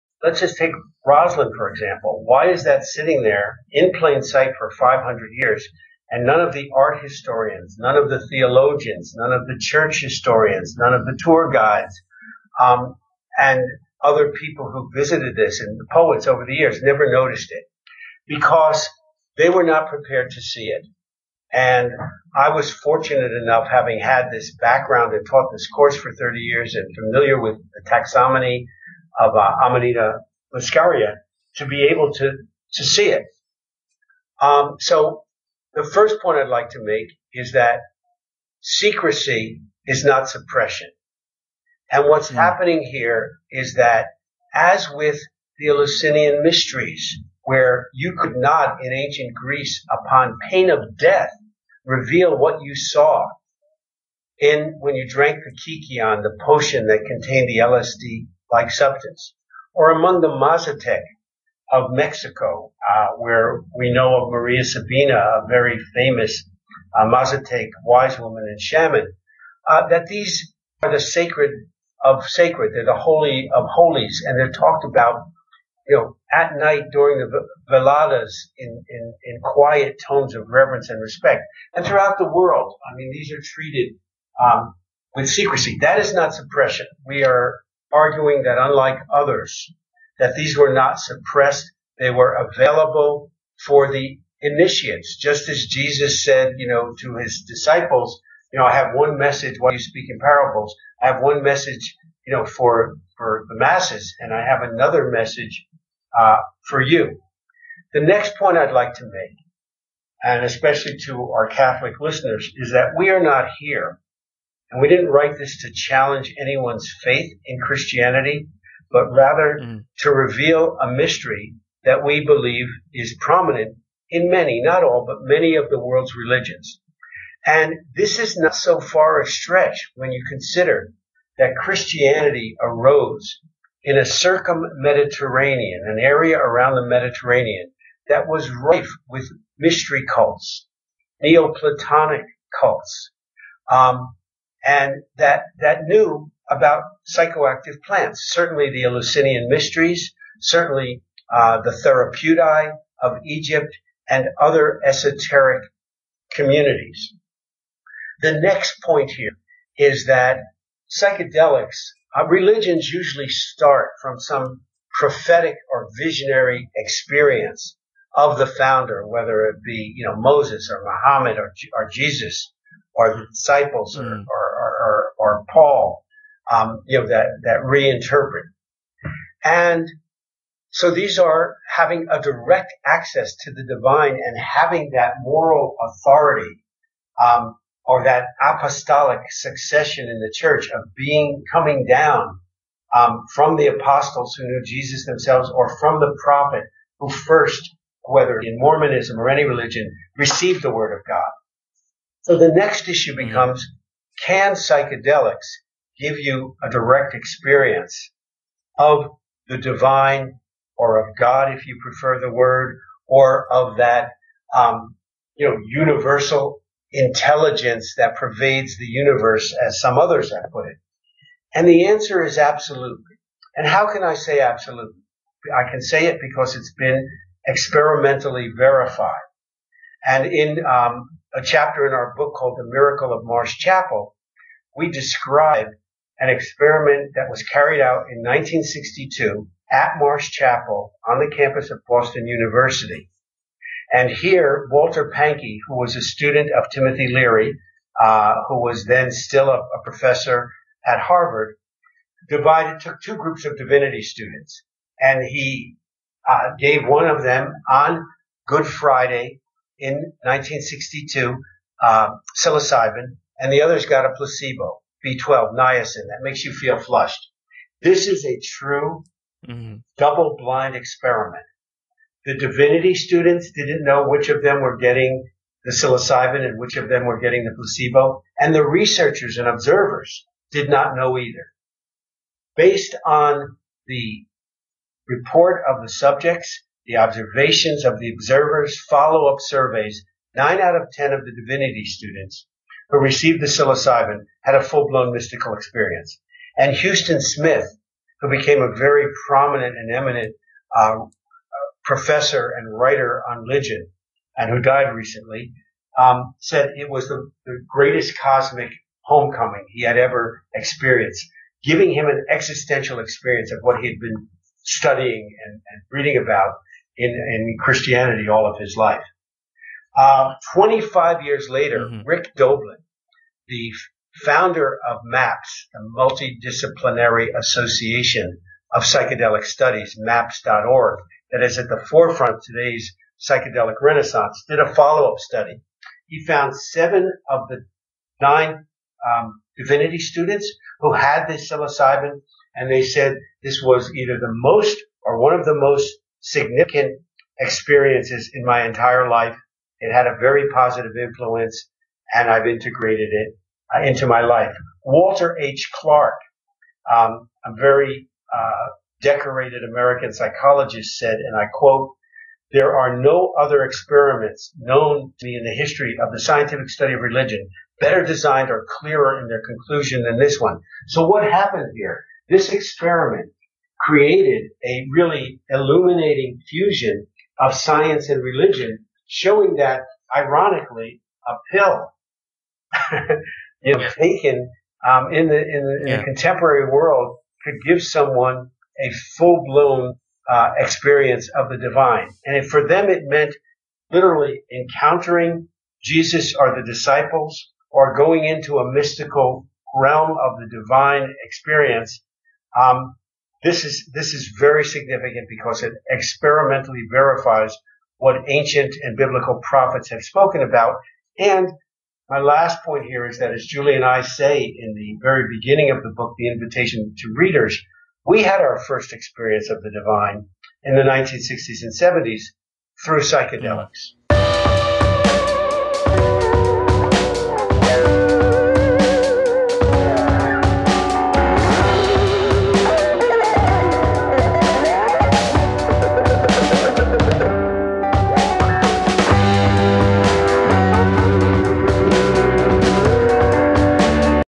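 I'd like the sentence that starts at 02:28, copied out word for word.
Certainly the Eleusinian mysteries, certainly uh, the Therapeutae of Egypt and other esoteric communities.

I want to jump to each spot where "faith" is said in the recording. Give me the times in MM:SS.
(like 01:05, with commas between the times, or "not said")
01:57.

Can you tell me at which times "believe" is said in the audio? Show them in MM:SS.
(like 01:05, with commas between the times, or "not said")
02:02.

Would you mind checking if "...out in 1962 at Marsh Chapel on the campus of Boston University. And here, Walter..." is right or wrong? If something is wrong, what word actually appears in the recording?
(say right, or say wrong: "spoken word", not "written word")
right.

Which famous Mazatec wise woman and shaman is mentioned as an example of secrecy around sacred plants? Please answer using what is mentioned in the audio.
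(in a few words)
Maria Sabina.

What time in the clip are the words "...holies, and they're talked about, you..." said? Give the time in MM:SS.
01:13.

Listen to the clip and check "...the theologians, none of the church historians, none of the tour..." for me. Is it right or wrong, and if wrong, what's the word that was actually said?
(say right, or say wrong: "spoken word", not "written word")
right.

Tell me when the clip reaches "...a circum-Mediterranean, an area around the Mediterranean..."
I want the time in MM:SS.
02:13.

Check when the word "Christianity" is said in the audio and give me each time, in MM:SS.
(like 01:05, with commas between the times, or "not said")
01:57, 02:11, 05:17.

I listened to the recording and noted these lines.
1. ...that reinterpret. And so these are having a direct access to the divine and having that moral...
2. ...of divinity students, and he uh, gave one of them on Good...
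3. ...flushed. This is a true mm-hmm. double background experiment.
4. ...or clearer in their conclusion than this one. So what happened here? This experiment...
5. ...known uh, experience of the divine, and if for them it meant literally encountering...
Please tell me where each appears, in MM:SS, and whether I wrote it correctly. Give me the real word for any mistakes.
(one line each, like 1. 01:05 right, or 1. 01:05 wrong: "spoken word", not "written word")
1. 02:57 right
2. 04:13 right
3. 04:26 wrong: "blind", not "background"
4. 06:08 right
5. 06:29 wrong: "blown", not "known".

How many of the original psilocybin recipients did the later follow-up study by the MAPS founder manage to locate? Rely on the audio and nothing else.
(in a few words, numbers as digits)
7.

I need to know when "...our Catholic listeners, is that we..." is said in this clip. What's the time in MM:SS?
01:51.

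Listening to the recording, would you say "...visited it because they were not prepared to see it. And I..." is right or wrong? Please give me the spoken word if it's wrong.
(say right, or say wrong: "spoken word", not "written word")
wrong: "noticed", not "visited".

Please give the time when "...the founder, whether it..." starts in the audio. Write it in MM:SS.
02:48.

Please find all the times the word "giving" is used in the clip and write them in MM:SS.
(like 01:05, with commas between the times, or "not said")
05:11.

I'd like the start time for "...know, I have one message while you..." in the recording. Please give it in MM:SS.
01:38.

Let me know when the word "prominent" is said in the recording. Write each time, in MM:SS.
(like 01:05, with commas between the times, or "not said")
02:03, 04:59.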